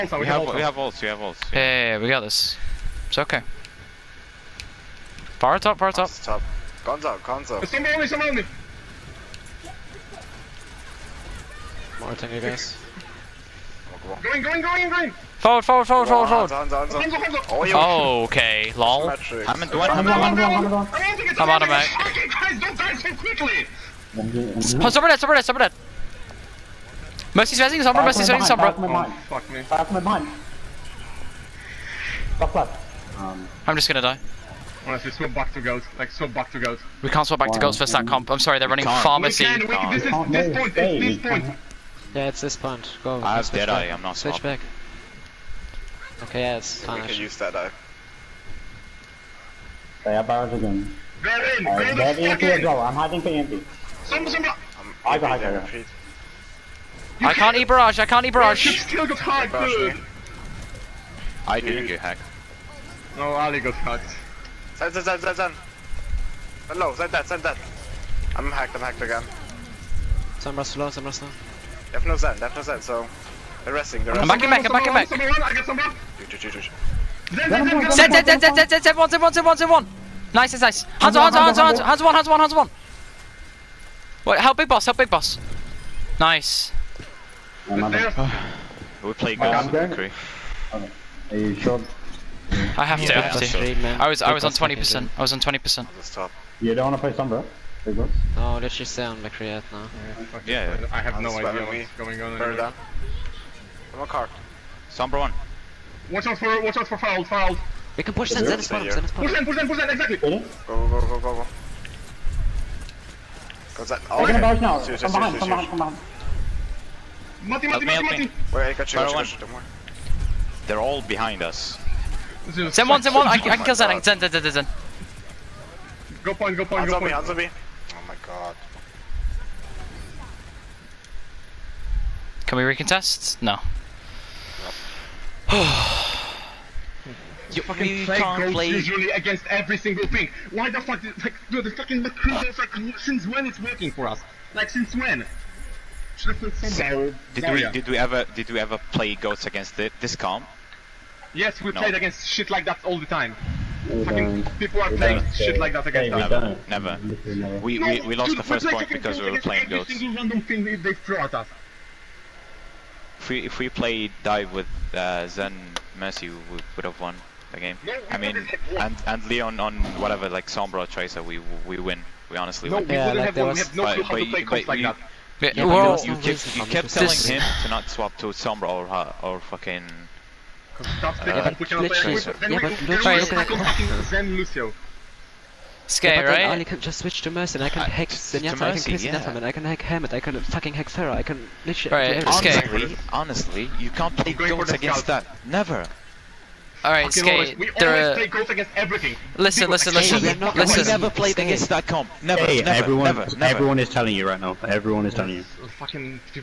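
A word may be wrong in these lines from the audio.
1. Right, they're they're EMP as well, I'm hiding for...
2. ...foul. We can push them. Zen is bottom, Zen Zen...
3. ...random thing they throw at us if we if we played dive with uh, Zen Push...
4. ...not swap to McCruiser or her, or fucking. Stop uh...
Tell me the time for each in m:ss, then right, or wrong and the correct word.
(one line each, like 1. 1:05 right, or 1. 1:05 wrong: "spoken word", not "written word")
1. 0:51 right
2. 1:47 wrong: "Push", not "Zen"
3. 2:40 wrong: "Mercy", not "Push"
4. 2:57 wrong: "Sombra", not "McCruiser".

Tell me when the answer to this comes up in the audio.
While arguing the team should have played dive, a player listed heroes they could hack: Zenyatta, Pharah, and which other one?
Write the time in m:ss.
3:09.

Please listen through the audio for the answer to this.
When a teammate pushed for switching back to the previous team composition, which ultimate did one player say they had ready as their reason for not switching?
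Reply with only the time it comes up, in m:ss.
0:43.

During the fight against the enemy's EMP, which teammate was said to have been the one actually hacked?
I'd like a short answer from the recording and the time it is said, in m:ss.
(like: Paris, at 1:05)
Ali, at 1:03.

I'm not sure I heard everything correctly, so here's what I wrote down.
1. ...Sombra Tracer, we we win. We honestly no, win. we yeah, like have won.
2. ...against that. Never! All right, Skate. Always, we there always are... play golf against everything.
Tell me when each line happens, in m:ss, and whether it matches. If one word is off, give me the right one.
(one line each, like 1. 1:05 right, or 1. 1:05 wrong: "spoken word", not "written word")
1. 2:50 right
2. 3:14 right.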